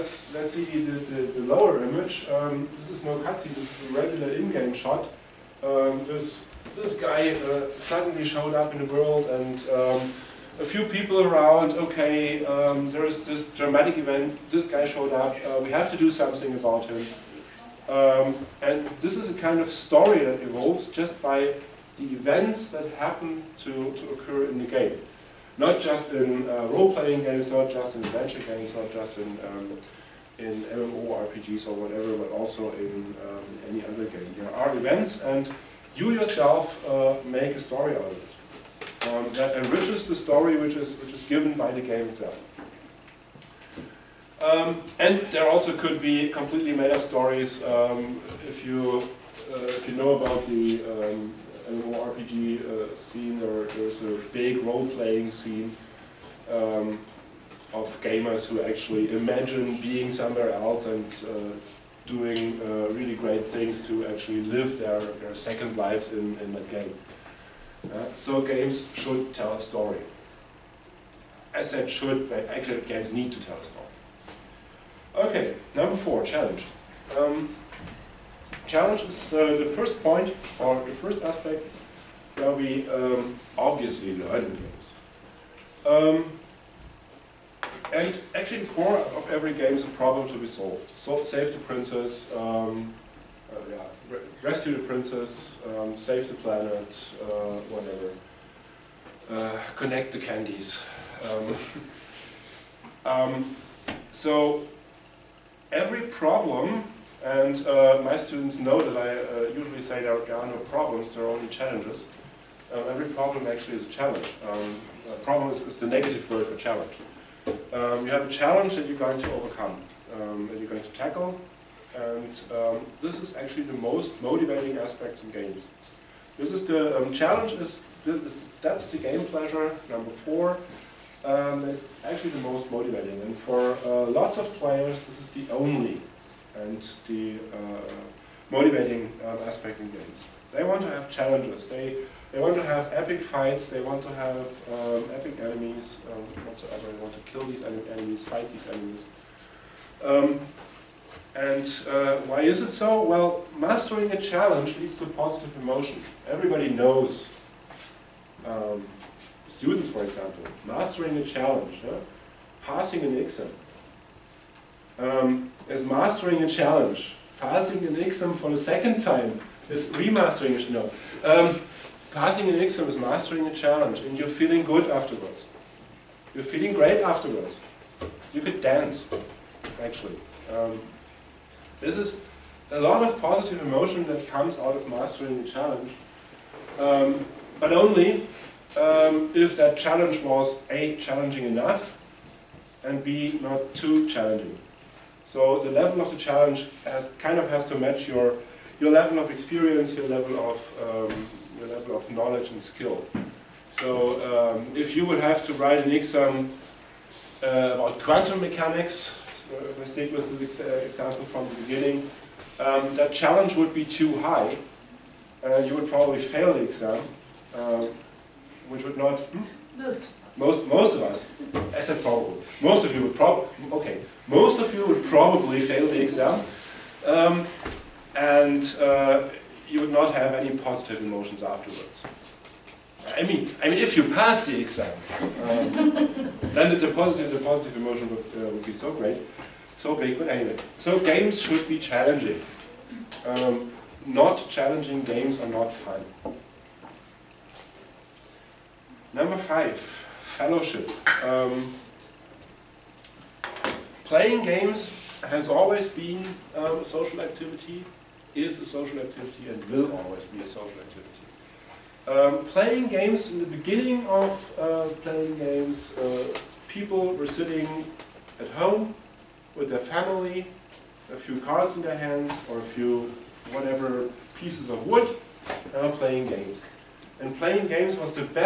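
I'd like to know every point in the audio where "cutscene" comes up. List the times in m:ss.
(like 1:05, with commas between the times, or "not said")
0:03.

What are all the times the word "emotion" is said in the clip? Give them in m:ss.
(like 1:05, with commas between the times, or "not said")
2:35, 3:03, 3:51, 3:57.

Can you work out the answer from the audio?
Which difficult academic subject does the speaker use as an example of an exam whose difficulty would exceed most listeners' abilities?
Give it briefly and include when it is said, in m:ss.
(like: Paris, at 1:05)
Quantum mechanics, at 3:27.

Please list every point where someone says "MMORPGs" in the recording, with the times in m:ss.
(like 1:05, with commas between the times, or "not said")
0:30, 0:51.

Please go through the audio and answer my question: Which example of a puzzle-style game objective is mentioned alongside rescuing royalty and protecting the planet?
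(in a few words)
Connect the candies.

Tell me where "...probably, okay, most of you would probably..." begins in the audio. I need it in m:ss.
3:43.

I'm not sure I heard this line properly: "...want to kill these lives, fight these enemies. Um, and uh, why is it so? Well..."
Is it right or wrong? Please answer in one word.
wrong.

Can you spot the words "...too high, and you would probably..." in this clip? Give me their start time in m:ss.
3:33.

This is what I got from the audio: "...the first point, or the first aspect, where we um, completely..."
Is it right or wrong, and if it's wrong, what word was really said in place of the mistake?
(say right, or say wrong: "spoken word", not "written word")
wrong: "obviously", not "completely".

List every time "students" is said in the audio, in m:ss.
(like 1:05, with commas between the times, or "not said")
1:48, 2:39.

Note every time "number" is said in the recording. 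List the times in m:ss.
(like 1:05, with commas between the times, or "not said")
1:15, 2:09, 4:09.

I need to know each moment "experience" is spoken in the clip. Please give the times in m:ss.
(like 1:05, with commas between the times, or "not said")
3:19.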